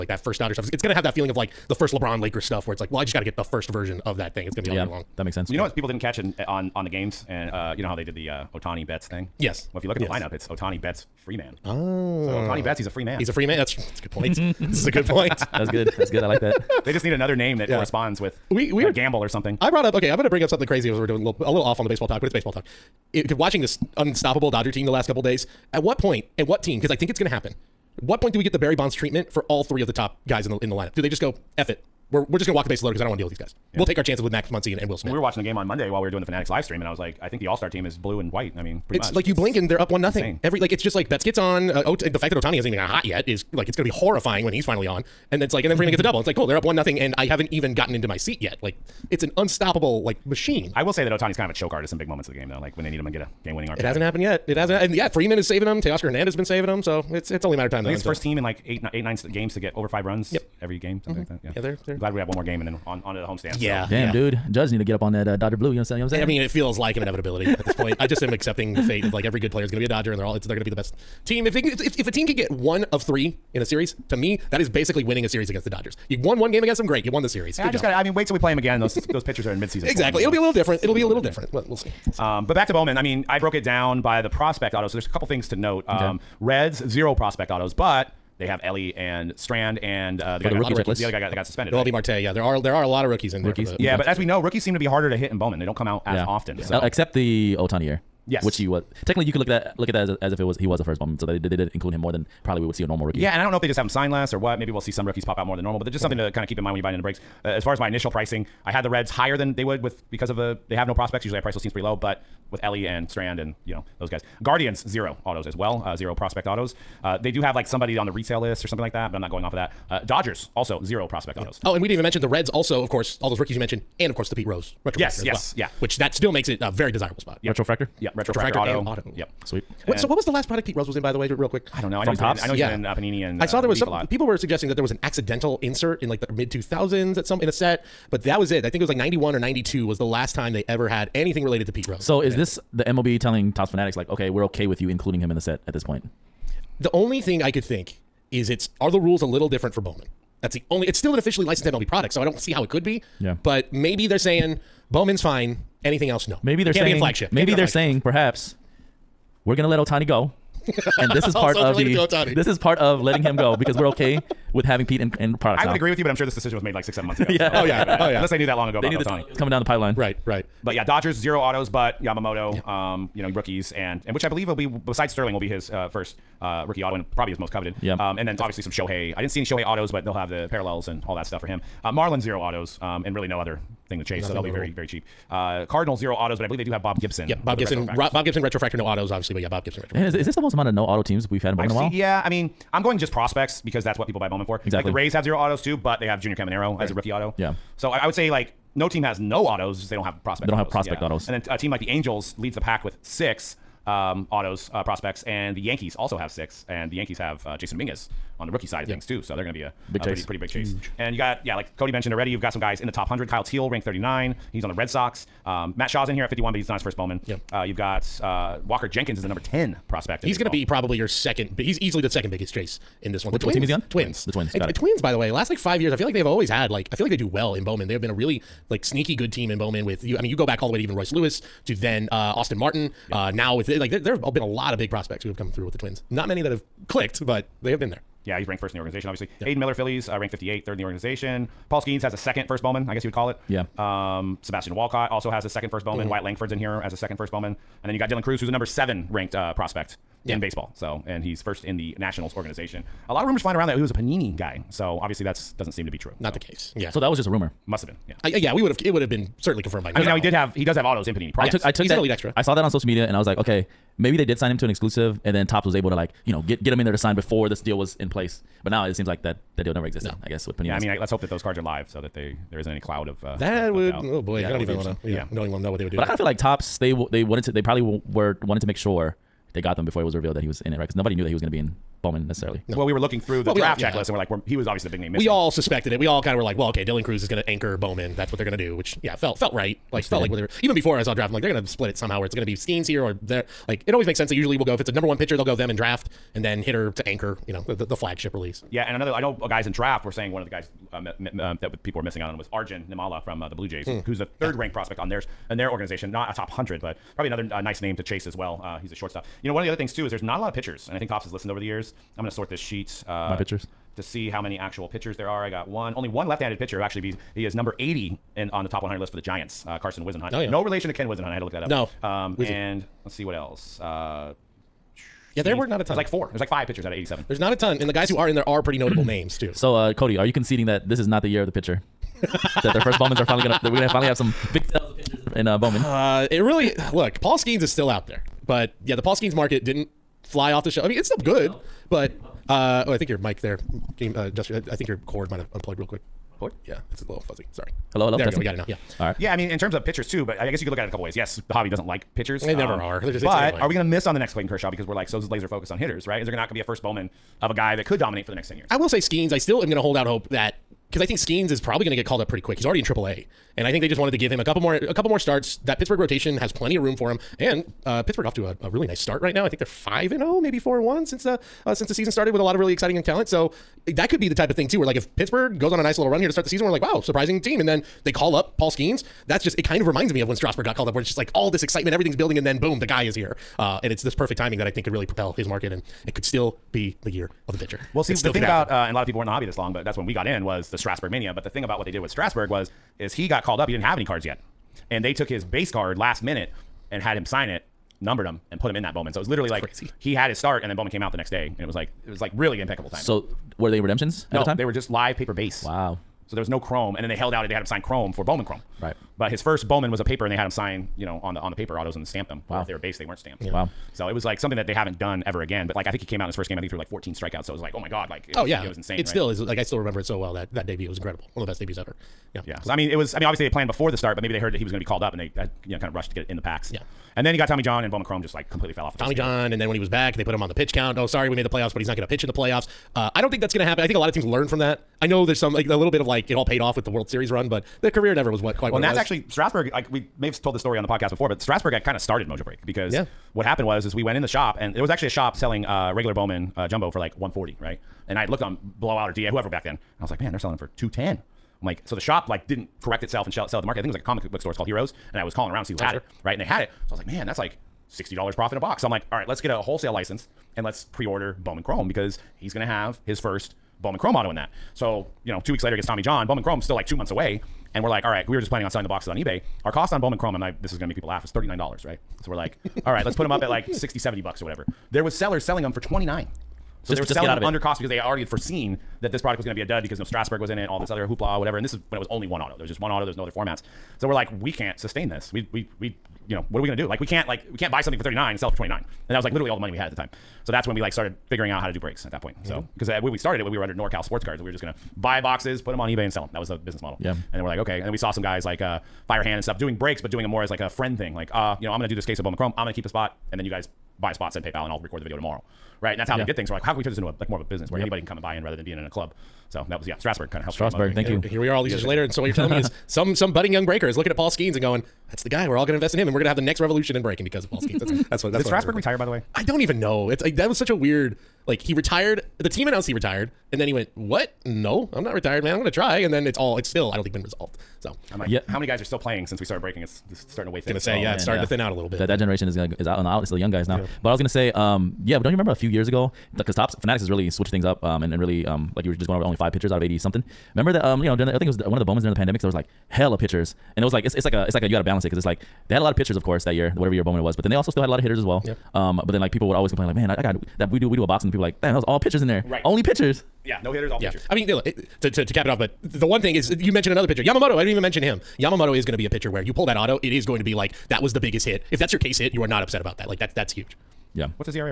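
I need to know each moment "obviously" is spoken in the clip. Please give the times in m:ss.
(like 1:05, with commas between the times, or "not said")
2:58, 3:09, 3:59, 4:14, 4:44, 7:03.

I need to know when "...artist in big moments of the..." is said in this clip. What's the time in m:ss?
0:51.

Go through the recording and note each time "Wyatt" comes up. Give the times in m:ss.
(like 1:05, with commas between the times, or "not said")
4:06.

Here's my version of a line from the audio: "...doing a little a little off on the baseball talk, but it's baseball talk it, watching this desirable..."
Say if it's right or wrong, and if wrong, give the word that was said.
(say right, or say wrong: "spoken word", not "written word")
wrong: "unstoppable", not "desirable".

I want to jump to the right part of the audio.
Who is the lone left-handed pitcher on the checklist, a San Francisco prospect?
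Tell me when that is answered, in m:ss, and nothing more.
5:19.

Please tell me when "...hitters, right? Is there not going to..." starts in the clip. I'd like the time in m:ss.
5:55.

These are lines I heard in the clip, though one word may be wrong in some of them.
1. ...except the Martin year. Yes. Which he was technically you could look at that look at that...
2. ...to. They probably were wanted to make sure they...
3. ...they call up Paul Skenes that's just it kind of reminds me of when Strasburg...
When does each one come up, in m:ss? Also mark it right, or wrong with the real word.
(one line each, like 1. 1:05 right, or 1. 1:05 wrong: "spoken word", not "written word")
1. 1:36 wrong: "Ohtani", not "Martin"
2. 4:37 right
3. 6:18 right.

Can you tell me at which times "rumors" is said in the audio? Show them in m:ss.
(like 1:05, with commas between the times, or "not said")
4:13, 4:17.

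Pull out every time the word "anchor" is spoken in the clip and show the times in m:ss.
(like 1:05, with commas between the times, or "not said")
4:47, 4:57.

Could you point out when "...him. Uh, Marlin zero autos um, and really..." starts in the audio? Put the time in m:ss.
3:01.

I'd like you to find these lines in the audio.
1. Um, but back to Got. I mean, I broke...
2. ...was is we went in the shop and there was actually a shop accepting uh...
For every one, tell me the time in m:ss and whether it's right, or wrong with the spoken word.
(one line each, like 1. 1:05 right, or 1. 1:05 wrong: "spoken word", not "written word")
1. 1:22 wrong: "Bowman", not "Got"
2. 7:23 wrong: "selling", not "accepting".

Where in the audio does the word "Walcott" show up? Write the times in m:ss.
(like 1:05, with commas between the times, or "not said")
4:04.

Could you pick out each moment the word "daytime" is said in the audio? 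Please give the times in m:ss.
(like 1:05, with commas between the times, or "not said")
not said.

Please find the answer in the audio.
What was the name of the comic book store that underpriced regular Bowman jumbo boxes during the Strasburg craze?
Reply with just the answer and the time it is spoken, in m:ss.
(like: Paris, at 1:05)
Heroes, at 7:34.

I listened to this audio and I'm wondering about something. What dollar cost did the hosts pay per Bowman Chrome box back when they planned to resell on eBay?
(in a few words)
$39.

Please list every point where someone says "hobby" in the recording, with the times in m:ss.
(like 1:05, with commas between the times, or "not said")
5:51, 6:29.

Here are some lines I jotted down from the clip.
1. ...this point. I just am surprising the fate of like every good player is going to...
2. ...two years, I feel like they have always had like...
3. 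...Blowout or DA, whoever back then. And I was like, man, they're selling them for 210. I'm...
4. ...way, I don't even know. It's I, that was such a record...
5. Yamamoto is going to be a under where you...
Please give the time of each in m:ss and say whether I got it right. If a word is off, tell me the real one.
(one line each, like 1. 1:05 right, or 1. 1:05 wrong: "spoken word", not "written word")
1. 1:07 wrong: "accepting", not "surprising"
2. 3:45 wrong: "five", not "two"
3. 7:28 right
4. 8:39 wrong: "weird", not "record"
5. 9:18 wrong: "pitcher", not "under".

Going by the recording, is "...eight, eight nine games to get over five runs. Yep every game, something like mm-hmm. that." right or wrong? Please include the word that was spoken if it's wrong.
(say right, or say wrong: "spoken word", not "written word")
right.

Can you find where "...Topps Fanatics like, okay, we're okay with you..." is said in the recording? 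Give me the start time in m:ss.
2:23.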